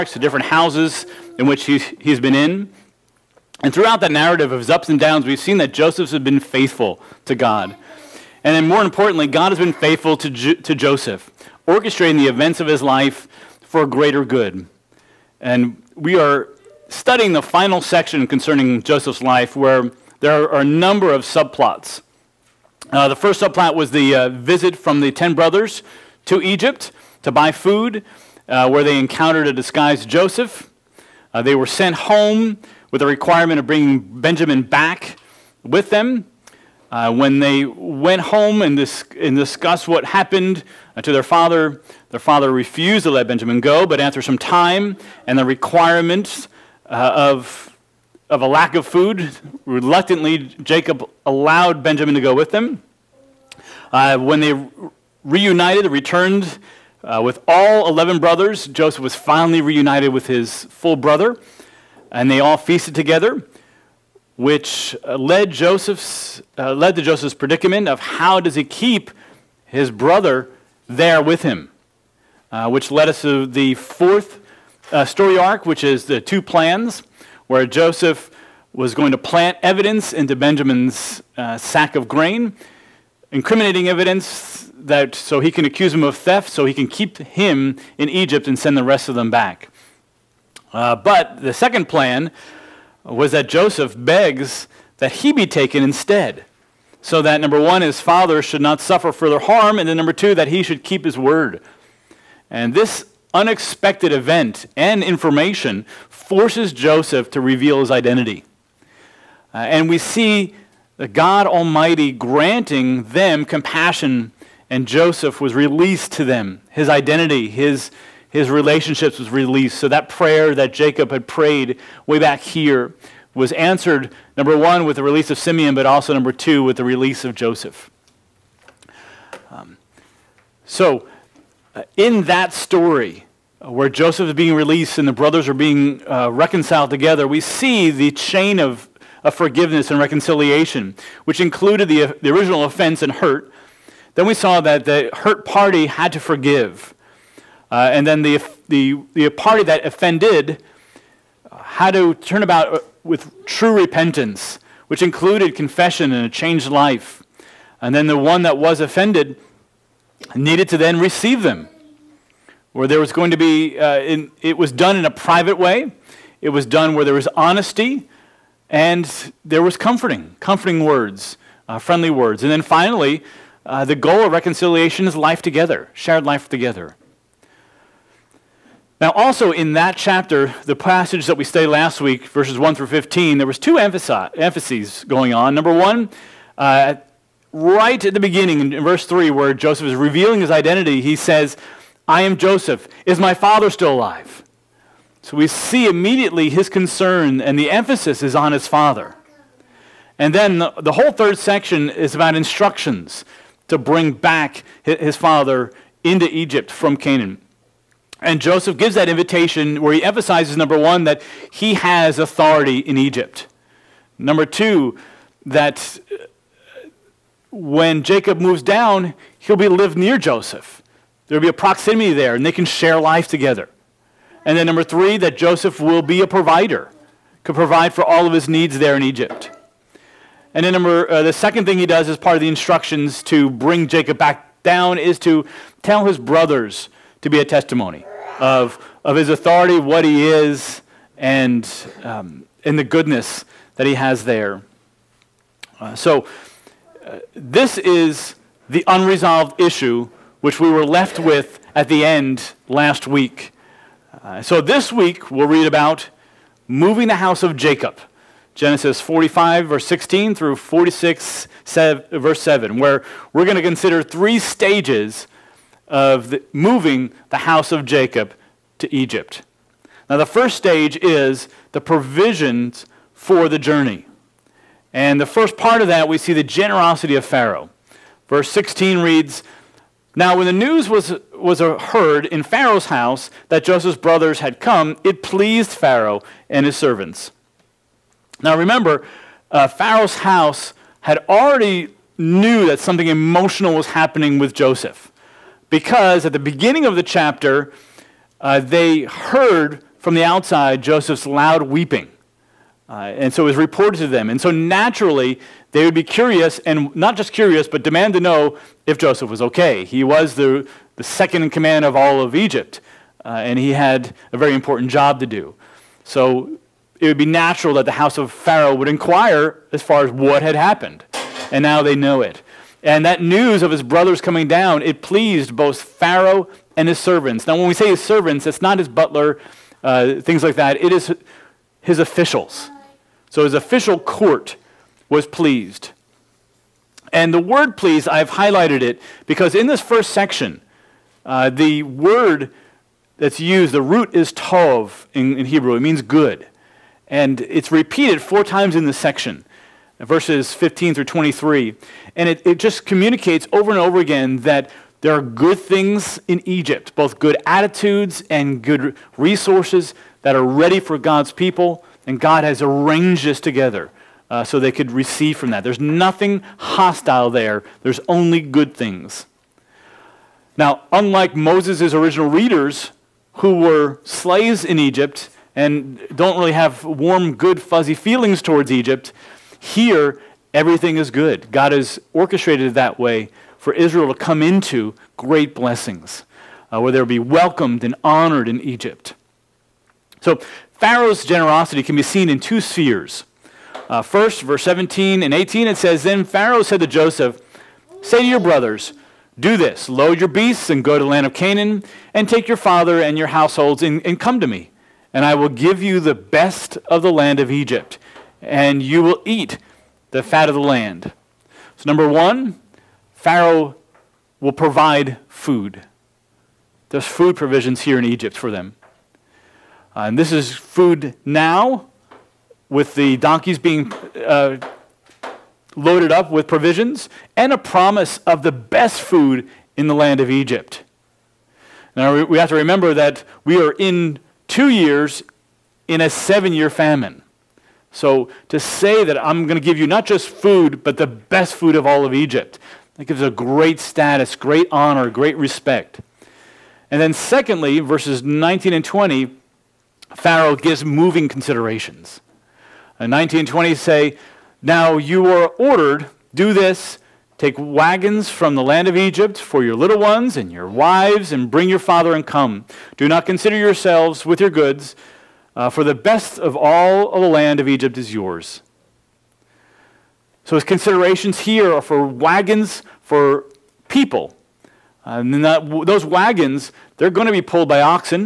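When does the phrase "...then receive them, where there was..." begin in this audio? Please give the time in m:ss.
2:40.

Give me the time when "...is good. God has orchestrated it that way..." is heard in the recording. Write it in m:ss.
6:20.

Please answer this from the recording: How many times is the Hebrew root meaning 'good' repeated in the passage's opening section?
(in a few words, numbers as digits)
4.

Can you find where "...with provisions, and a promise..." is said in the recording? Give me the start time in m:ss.
7:06.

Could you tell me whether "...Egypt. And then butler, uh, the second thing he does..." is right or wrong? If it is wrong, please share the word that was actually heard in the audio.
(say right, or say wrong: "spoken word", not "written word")
wrong: "number", not "butler".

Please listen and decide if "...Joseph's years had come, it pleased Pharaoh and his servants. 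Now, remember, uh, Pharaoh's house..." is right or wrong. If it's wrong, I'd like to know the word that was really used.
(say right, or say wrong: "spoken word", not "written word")
wrong: "brothers", not "years".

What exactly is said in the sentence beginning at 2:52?
And then finally, uh, the goal of reconciliation is life together, shared life together.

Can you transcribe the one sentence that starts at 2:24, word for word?
Then we saw that the hurt party had to forgive.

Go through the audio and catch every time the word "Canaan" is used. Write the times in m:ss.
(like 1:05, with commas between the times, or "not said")
3:26, 6:41.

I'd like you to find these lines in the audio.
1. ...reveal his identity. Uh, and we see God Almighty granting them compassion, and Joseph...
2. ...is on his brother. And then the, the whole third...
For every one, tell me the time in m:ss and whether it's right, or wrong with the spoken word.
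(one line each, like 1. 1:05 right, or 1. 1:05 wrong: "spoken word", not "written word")
1. 1:47 right
2. 3:18 wrong: "father", not "brother".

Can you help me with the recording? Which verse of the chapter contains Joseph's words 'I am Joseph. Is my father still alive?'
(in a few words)
Verse 3.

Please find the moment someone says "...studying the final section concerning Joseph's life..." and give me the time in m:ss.
0:16.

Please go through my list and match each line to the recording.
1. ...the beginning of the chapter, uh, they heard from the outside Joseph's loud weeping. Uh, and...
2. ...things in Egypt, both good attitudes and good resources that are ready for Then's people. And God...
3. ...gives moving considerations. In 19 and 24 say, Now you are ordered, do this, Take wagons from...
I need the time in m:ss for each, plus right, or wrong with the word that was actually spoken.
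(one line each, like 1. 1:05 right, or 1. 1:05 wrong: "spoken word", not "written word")
1. 4:56 right
2. 5:55 wrong: "God", not "Then"
3. 7:30 wrong: "20", not "24".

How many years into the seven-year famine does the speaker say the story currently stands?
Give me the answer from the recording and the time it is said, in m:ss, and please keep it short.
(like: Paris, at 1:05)
2, at 7:14.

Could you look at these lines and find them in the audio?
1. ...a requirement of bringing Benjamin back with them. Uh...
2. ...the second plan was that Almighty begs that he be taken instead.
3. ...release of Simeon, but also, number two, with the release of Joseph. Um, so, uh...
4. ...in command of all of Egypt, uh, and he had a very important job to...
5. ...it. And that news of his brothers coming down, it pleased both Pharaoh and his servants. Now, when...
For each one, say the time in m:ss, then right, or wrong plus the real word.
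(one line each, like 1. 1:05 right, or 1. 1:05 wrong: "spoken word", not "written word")
1. 0:33 right
2. 1:31 wrong: "Joseph", not "Almighty"
3. 2:05 right
4. 5:11 right
5. 5:22 right.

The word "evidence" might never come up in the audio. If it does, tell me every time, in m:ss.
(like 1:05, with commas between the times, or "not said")
1:19, 1:23.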